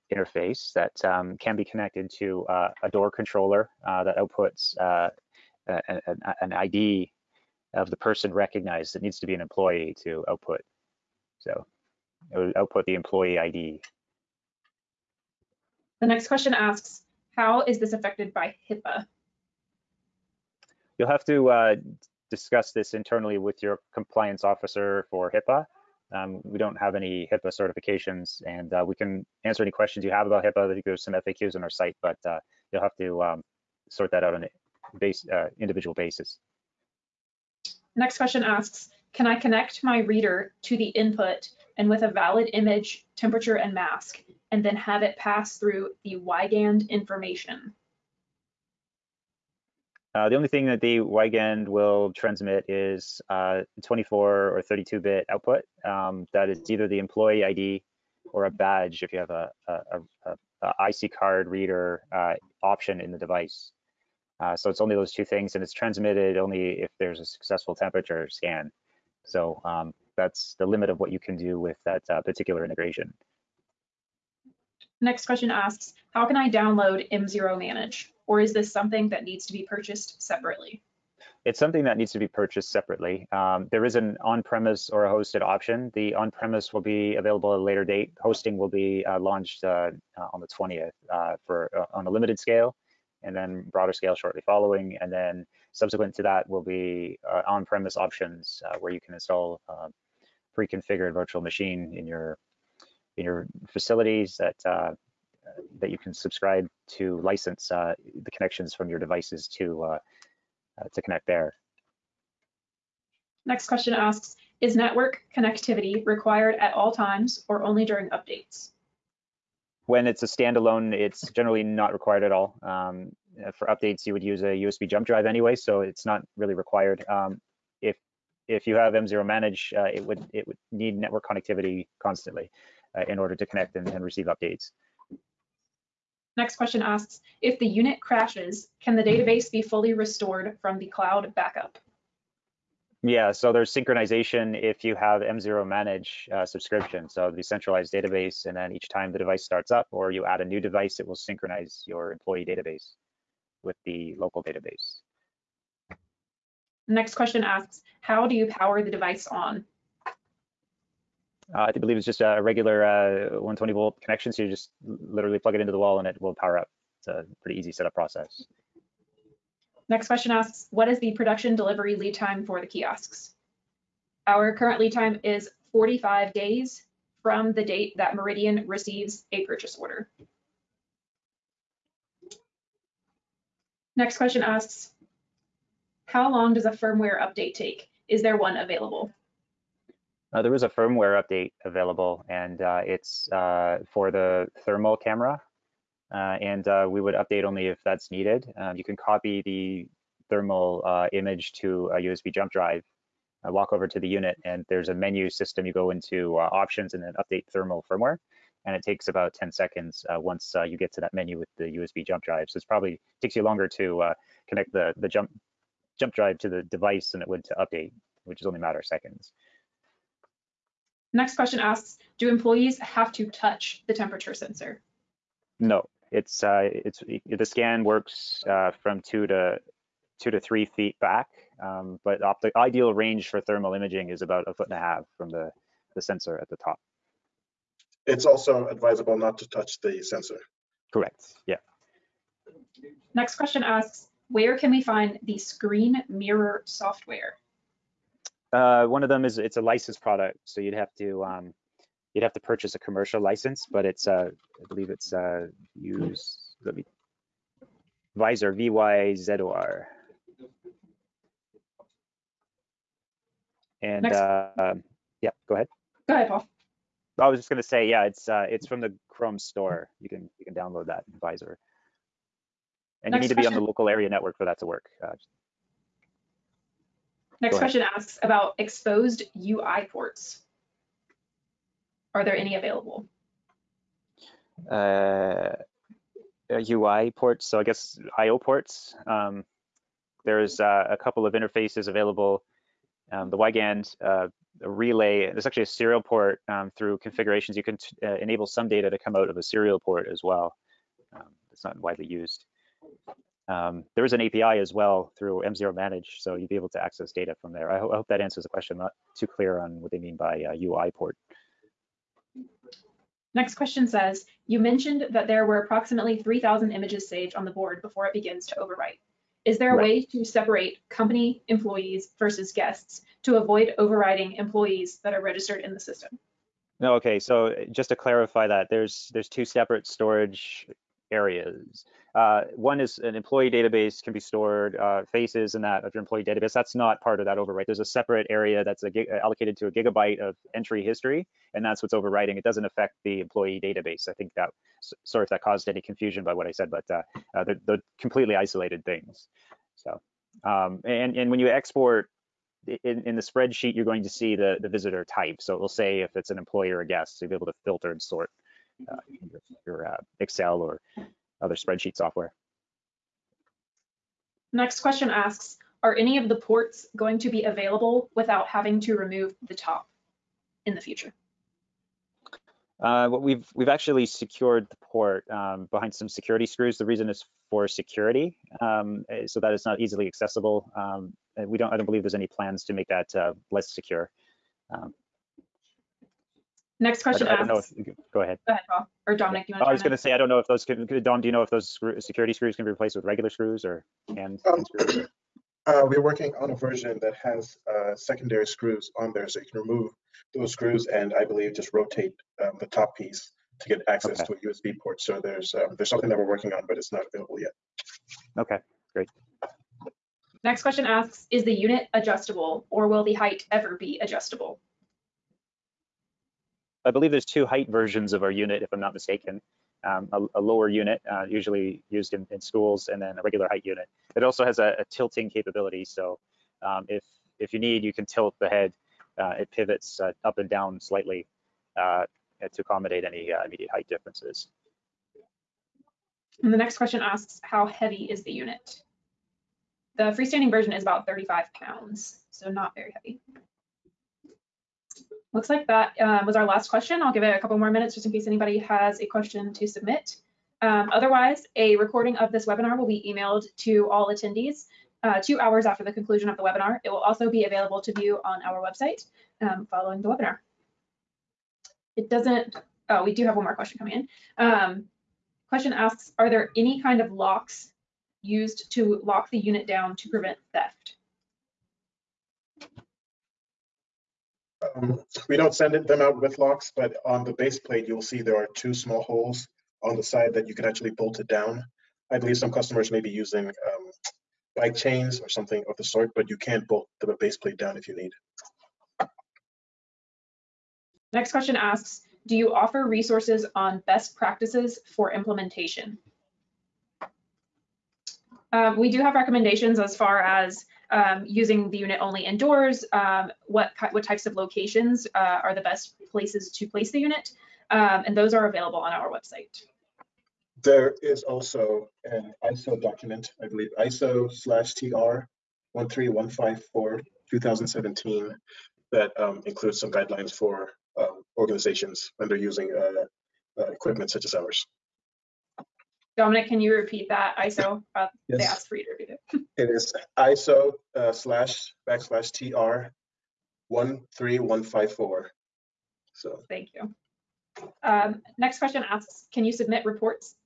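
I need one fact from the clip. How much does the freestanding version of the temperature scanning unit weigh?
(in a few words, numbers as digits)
35 pounds.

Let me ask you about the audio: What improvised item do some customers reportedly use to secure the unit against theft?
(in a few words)
bike chains.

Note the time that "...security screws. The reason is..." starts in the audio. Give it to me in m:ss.
6:16.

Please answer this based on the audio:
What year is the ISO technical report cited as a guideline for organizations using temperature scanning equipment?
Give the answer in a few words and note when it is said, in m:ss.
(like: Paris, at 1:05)
2017, at 8:37.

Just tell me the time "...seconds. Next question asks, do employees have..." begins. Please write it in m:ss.
3:38.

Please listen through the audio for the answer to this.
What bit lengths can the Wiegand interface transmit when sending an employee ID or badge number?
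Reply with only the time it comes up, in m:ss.
0:53.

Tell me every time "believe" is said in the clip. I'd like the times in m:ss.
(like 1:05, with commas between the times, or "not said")
2:41, 4:14, 6:21, 6:41, 6:56, 8:02, 8:33.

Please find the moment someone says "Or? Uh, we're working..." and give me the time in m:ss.
6:35.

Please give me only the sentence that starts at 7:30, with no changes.
Um, otherwise, a recording of this webinar will be emailed to all attendees uh, two hours after the conclusion of the webinar.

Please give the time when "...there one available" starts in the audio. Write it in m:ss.
3:08.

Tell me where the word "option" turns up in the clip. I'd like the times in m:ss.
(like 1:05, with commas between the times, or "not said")
1:02, 1:25, 1:37, 3:26.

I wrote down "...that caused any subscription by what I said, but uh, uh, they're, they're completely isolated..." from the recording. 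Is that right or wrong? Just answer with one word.
wrong.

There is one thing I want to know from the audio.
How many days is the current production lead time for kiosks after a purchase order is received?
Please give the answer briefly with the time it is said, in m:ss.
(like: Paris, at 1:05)
45 days, at 2:55.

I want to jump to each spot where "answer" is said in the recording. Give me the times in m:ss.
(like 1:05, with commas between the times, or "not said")
0:29, 5:08.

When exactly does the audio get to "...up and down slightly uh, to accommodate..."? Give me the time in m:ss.
7:10.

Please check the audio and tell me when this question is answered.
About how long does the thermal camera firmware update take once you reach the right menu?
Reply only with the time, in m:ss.
3:29.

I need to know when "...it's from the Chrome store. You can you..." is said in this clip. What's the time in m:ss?
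4:28.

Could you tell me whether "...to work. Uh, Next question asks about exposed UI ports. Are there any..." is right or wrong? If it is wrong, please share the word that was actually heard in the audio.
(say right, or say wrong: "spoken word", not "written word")
right.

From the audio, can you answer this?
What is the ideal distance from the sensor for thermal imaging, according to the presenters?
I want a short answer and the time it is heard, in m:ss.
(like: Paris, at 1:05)
a foot and a half, at 3:54.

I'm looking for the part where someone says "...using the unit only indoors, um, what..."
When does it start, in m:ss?
8:21.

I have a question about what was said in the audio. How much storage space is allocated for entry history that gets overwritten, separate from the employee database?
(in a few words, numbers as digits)
a gigabyte.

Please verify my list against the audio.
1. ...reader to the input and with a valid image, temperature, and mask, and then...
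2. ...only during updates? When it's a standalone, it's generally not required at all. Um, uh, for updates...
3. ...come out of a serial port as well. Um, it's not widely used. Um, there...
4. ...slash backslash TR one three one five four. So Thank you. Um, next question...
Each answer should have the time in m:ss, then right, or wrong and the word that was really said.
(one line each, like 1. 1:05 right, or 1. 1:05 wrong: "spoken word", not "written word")
1. 0:40 right
2. 1:57 right
3. 4:58 right
4. 8:51 right.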